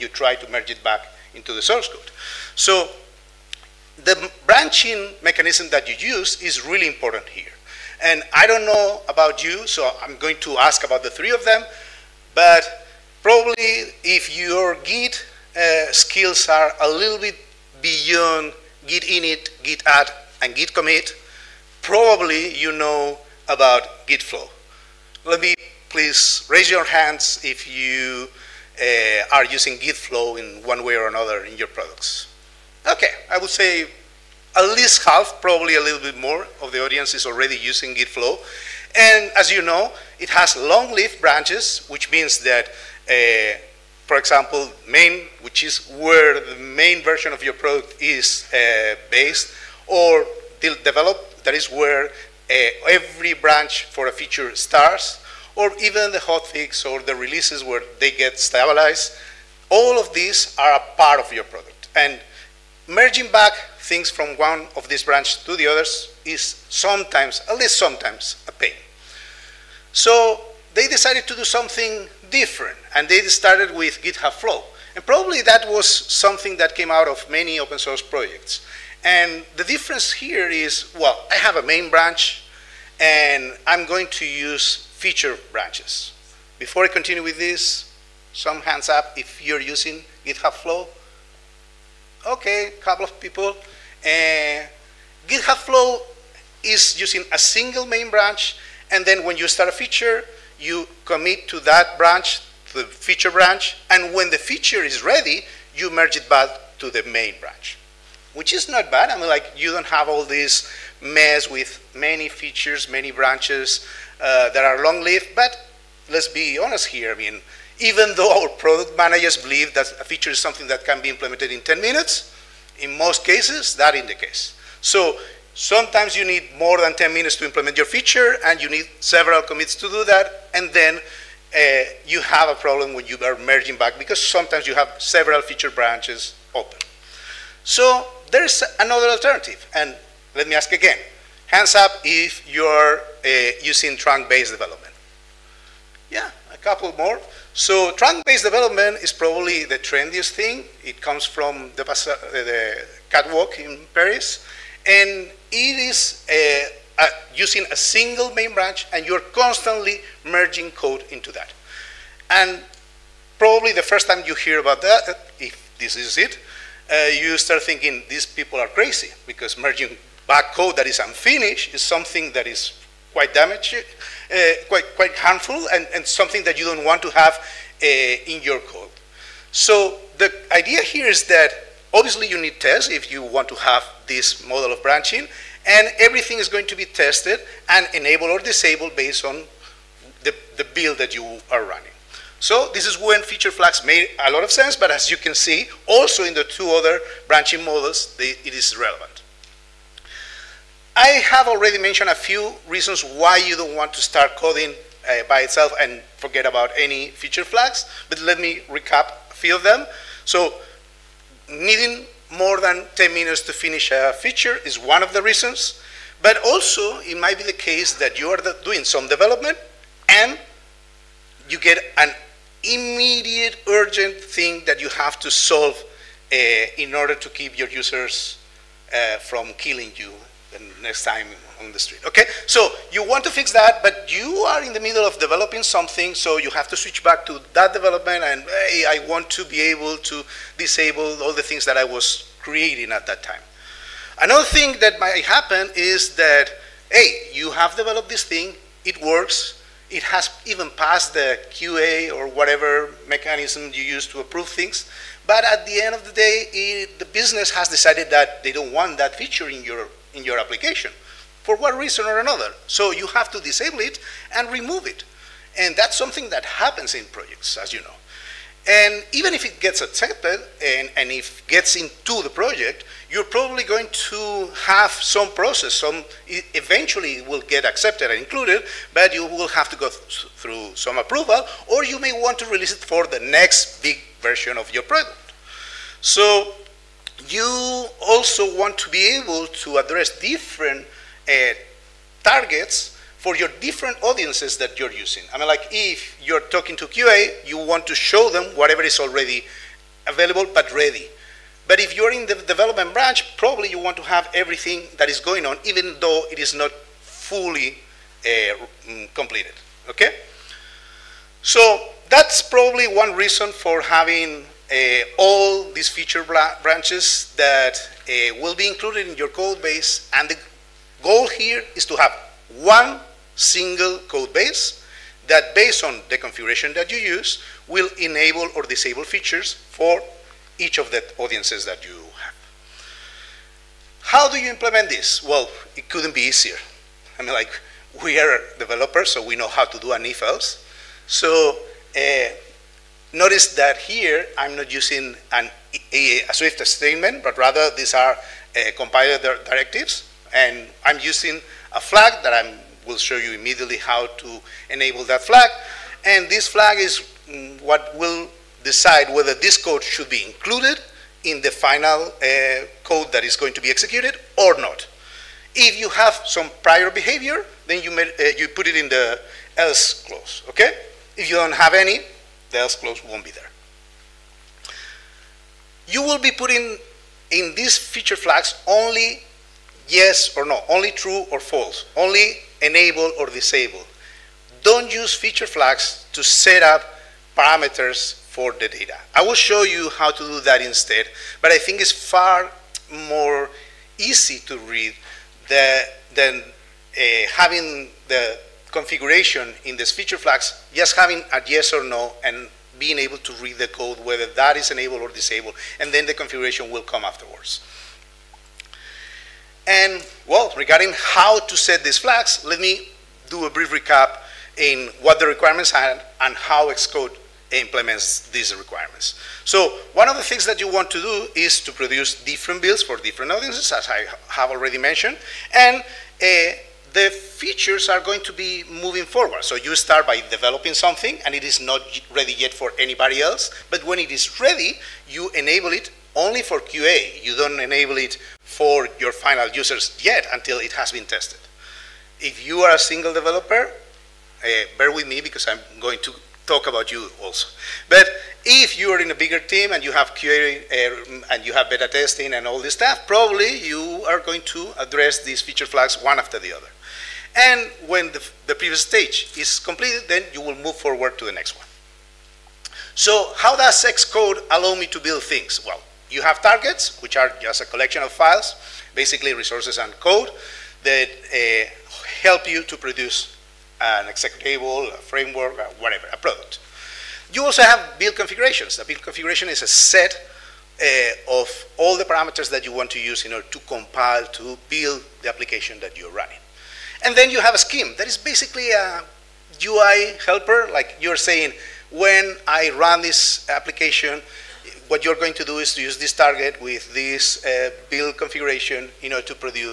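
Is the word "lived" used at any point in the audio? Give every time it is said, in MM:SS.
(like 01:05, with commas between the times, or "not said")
00:40, 01:54.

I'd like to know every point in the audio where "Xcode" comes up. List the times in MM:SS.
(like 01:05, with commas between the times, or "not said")
06:56, 07:43.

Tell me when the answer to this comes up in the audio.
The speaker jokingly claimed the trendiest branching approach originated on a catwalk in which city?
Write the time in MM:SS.
02:33.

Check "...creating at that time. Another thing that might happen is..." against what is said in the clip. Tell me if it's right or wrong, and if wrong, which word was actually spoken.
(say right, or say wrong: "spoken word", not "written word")
right.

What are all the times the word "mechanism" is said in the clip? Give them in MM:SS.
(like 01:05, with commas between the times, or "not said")
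00:05, 04:13.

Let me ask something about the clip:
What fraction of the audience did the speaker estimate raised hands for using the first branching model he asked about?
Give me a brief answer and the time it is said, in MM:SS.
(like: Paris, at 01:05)
at least half, at 00:34.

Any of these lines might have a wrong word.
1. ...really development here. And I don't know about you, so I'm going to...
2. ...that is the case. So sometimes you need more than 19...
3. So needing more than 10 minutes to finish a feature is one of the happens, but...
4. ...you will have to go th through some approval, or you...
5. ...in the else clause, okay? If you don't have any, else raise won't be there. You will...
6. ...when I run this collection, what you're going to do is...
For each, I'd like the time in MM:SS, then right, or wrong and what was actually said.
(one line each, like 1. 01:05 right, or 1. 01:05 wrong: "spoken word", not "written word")
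1. 00:06 wrong: "important", not "development"
2. 02:03 wrong: "10", not "19"
3. 03:30 wrong: "reasons", not "happens"
4. 04:39 right
5. 06:08 wrong: "clause", not "raise"
6. 08:11 wrong: "application", not "collection".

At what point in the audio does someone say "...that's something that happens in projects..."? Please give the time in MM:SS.
04:25.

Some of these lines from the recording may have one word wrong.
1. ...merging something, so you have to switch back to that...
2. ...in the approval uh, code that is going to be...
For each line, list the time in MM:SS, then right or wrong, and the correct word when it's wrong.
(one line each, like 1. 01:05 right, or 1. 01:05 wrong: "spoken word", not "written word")
1. 03:55 wrong: "developing", not "merging"
2. 06:01 wrong: "final", not "approval".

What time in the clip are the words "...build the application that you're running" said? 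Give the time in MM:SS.
08:04.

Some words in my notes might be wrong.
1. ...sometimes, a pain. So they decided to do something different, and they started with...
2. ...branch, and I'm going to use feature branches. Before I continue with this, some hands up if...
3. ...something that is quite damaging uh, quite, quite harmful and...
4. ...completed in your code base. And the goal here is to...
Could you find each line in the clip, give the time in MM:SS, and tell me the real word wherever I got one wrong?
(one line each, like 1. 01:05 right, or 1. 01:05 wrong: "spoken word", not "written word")
1. 01:07 right
2. 01:21 right
3. 02:51 right
4. 05:18 wrong: "included", not "completed".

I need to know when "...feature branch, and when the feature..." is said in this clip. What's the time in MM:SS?
01:42.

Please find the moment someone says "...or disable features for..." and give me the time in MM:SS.
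05:28.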